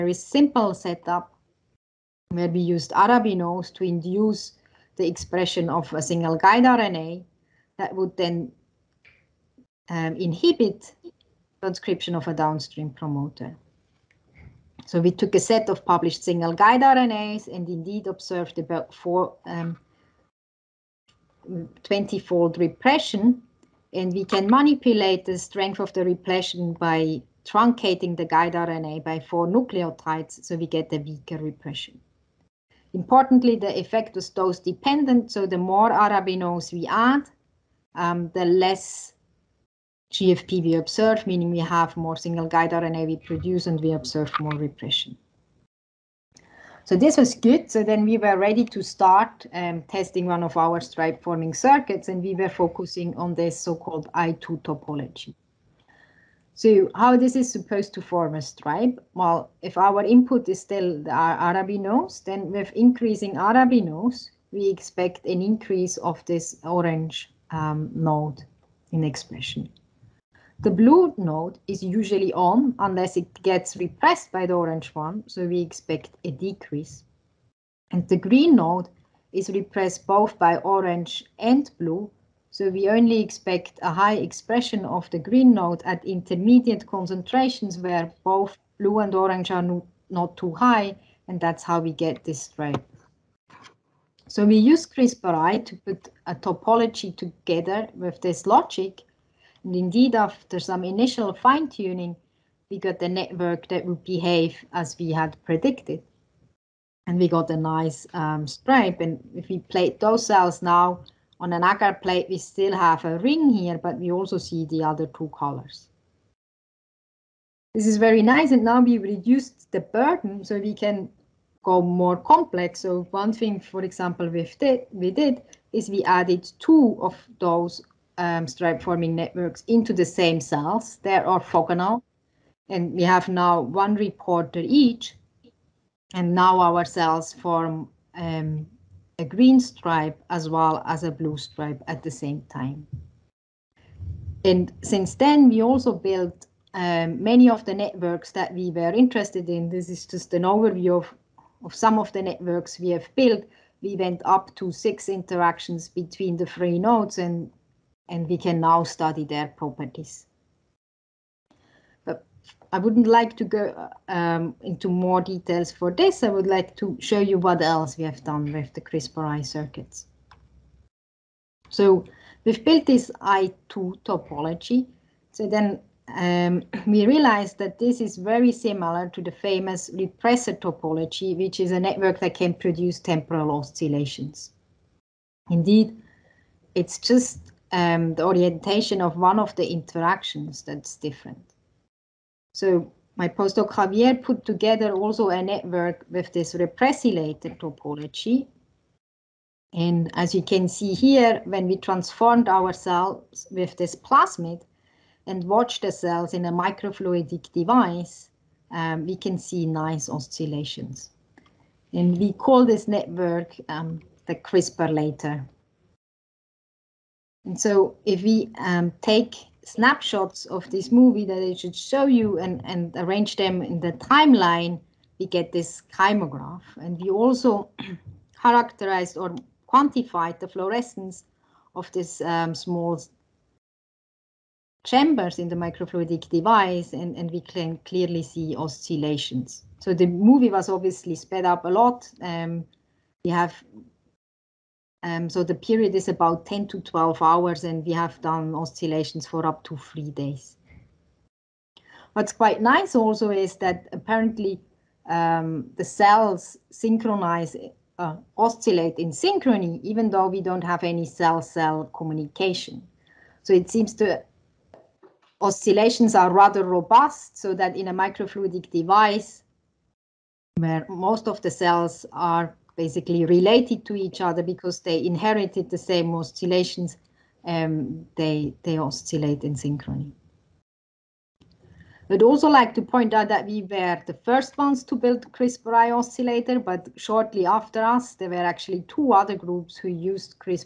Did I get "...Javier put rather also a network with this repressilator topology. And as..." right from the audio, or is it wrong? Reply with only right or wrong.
wrong.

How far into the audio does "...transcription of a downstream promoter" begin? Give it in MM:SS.
00:11.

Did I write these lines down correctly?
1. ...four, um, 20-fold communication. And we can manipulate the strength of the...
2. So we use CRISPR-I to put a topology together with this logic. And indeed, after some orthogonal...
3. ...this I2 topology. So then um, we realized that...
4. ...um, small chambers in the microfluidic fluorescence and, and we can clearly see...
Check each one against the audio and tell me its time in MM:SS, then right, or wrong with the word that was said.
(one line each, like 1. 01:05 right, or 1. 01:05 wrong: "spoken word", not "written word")
1. 00:18 wrong: "repression", not "communication"
2. 01:34 wrong: "initial", not "orthogonal"
3. 02:52 right
4. 03:52 wrong: "device", not "fluorescence".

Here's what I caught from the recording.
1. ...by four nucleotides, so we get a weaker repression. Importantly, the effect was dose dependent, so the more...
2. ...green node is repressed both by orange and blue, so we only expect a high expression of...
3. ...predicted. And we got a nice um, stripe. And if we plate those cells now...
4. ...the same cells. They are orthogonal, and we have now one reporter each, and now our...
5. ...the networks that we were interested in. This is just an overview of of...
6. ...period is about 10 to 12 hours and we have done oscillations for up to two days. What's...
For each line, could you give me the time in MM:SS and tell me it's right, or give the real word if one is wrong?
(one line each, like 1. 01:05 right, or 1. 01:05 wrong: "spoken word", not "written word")
1. 00:29 right
2. 01:18 right
3. 01:45 right
4. 02:09 right
5. 02:27 right
6. 04:05 wrong: "three", not "two".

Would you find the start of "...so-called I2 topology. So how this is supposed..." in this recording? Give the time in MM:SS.
00:53.